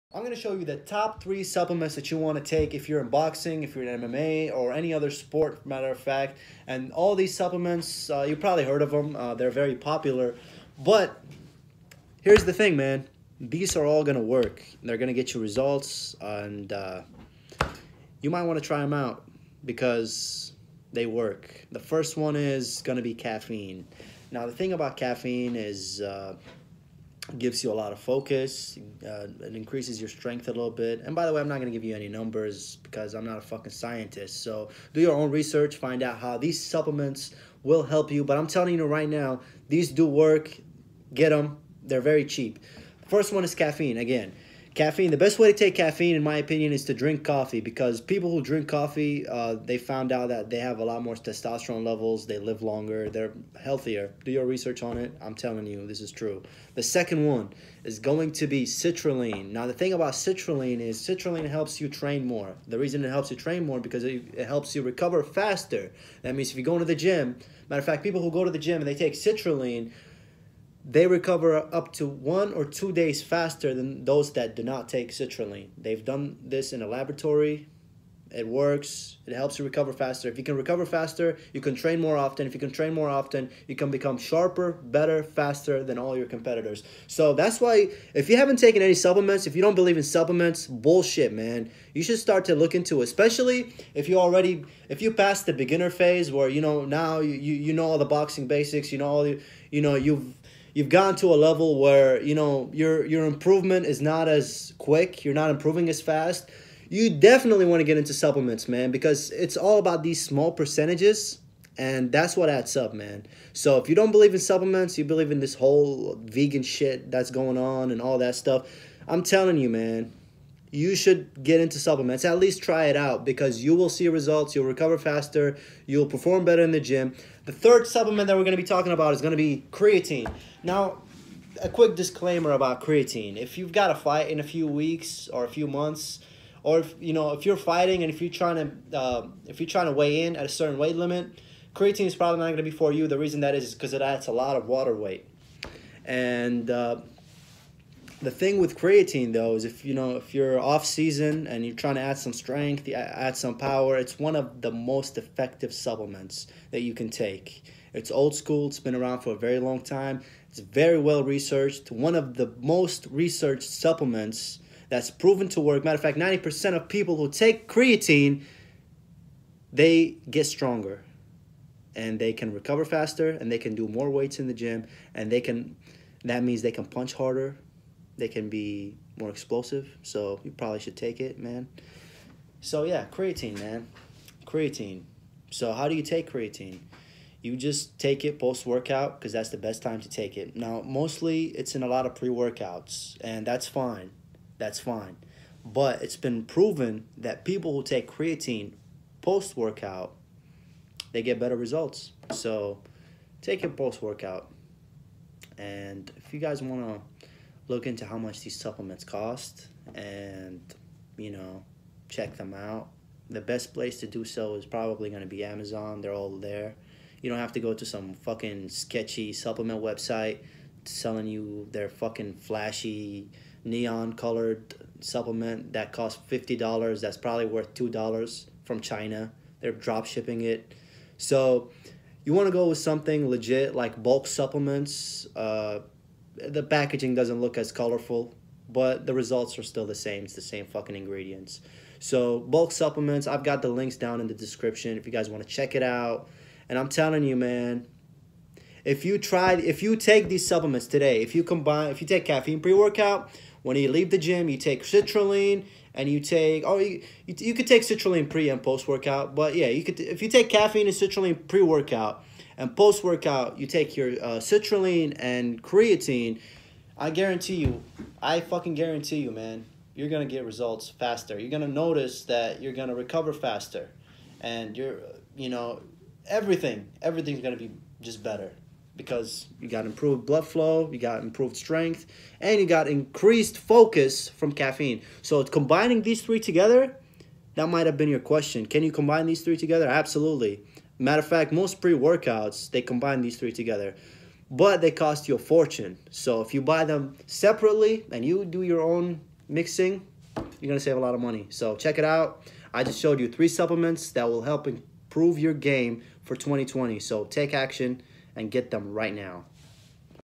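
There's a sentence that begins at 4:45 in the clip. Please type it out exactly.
So combining these three together, that might have been your question.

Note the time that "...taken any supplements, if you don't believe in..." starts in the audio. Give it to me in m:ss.
1:28.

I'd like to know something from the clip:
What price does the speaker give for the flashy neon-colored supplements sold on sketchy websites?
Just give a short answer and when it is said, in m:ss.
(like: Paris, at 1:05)
$50, at 3:46.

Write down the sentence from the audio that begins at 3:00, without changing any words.
So you probably should take it, man.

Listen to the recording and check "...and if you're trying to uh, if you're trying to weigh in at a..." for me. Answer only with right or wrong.
right.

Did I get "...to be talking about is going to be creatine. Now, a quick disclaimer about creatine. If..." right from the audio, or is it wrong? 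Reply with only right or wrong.
right.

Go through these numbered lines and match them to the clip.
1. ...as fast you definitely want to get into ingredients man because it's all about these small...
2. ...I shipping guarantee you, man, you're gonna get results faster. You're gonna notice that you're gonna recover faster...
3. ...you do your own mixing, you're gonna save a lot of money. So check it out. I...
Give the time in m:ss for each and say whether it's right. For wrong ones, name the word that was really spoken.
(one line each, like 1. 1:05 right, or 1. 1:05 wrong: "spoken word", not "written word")
1. 1:45 wrong: "supplements", not "ingredients"
2. 4:28 wrong: "fucking", not "shipping"
3. 4:58 right.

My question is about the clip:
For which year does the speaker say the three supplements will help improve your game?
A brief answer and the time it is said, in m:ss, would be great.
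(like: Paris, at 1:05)
2020, at 5:06.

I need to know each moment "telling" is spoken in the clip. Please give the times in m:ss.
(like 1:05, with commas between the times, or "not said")
0:38, 0:55, 1:59, 4:06.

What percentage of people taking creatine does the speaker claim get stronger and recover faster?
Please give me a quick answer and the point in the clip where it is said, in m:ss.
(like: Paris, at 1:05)
90%, at 2:46.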